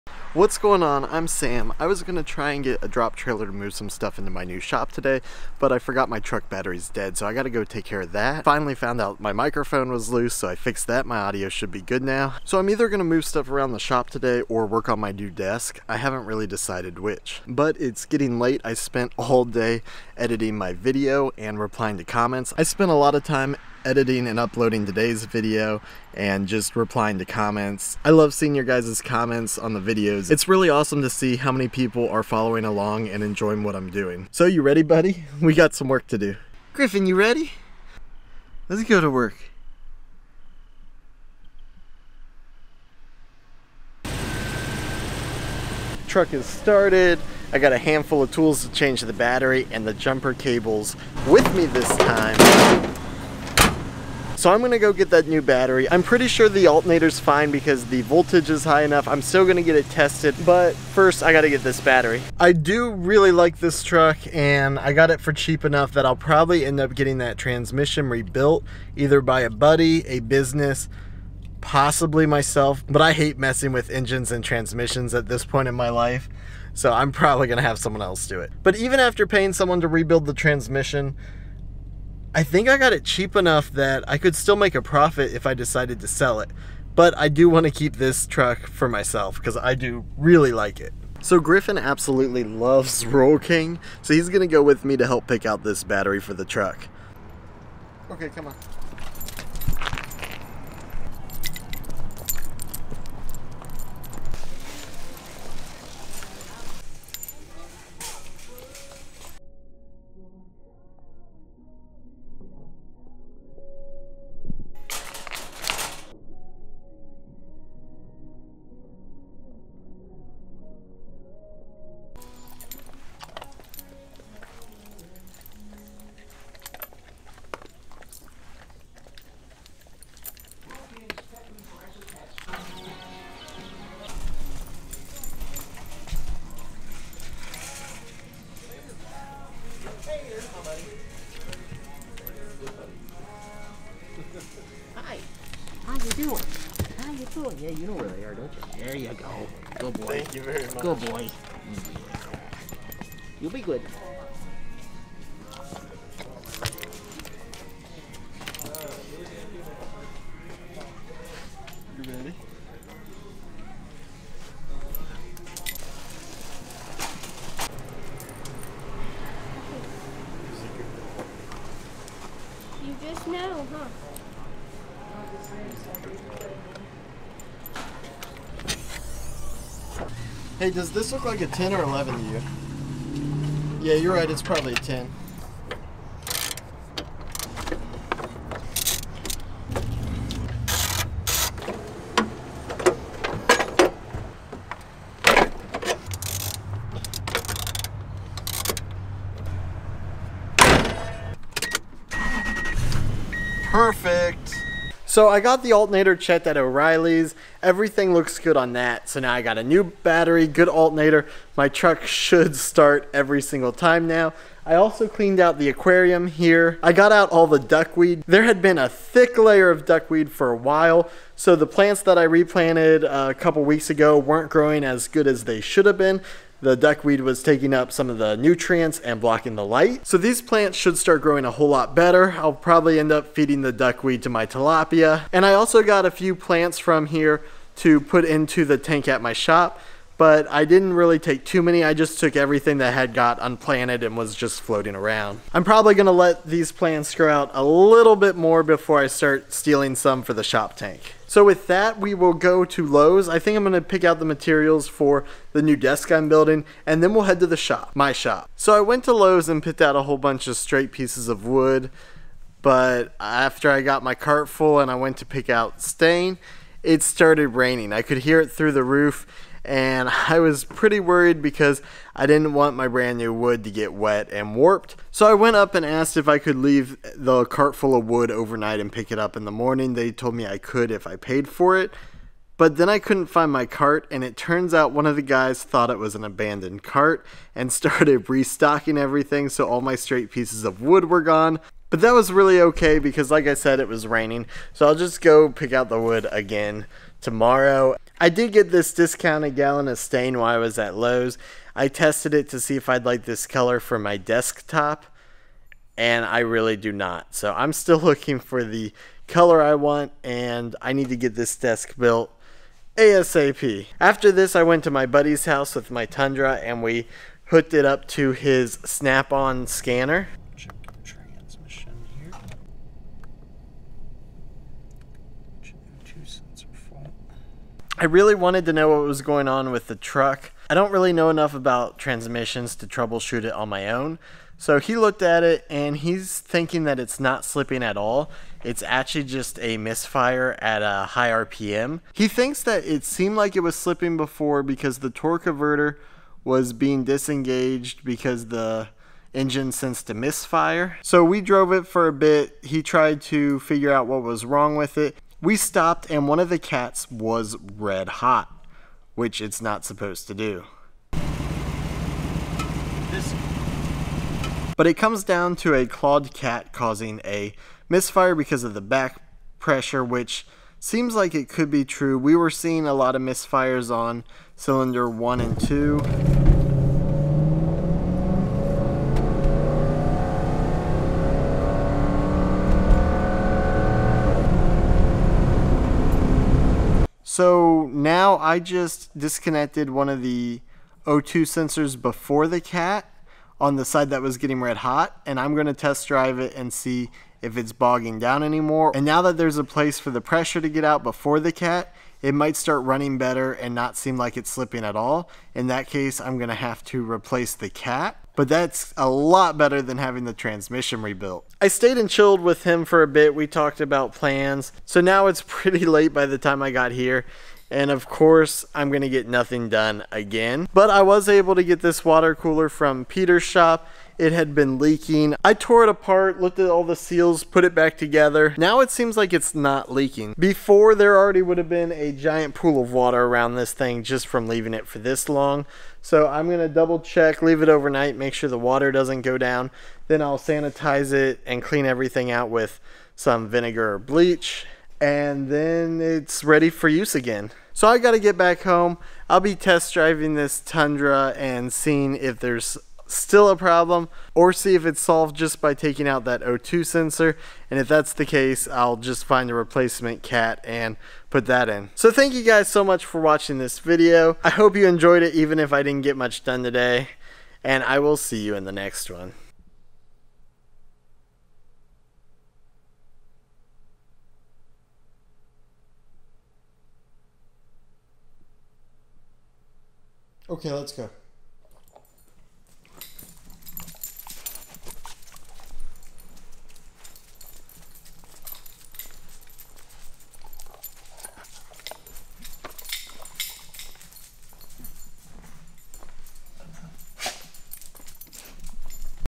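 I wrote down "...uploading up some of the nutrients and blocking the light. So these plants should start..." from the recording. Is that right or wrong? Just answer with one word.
wrong.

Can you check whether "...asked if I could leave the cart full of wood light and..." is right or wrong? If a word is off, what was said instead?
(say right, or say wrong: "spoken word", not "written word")
wrong: "overnight", not "light".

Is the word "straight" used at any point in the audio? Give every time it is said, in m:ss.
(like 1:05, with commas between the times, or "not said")
4:20, 4:49.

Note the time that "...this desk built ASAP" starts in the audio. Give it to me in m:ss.
5:11.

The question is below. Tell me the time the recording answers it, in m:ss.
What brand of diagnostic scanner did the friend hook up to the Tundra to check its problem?
5:18.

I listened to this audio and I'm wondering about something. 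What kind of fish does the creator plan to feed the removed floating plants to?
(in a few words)
Tilapia.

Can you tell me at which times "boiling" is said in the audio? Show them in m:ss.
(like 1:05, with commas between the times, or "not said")
not said.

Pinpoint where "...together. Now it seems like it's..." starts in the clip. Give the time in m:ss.
7:07.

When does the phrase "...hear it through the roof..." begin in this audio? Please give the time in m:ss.
4:28.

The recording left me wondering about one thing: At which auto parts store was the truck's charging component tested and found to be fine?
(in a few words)
O'Reilly's.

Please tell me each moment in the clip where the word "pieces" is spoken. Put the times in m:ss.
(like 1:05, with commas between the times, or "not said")
4:20, 4:50.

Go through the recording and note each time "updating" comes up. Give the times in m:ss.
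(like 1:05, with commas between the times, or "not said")
not said.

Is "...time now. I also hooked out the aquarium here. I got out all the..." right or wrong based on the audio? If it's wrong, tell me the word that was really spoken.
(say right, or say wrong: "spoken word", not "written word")
wrong: "cleaned", not "hooked".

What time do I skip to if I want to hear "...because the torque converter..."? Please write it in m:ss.
5:44.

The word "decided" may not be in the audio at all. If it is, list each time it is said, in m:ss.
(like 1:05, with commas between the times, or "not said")
0:16, 1:25.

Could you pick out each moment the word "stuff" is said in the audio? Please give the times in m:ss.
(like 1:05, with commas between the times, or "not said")
0:03, 0:13.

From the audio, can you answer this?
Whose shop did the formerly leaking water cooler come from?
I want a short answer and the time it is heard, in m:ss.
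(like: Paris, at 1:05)
Peter's, at 7:03.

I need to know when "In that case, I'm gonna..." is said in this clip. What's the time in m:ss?
6:45.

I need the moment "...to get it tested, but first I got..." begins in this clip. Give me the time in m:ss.
0:59.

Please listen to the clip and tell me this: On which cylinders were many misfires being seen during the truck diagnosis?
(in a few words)
1 and 2.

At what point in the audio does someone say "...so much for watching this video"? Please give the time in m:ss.
7:42.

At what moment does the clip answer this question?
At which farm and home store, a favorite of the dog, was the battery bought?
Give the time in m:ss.
1:33.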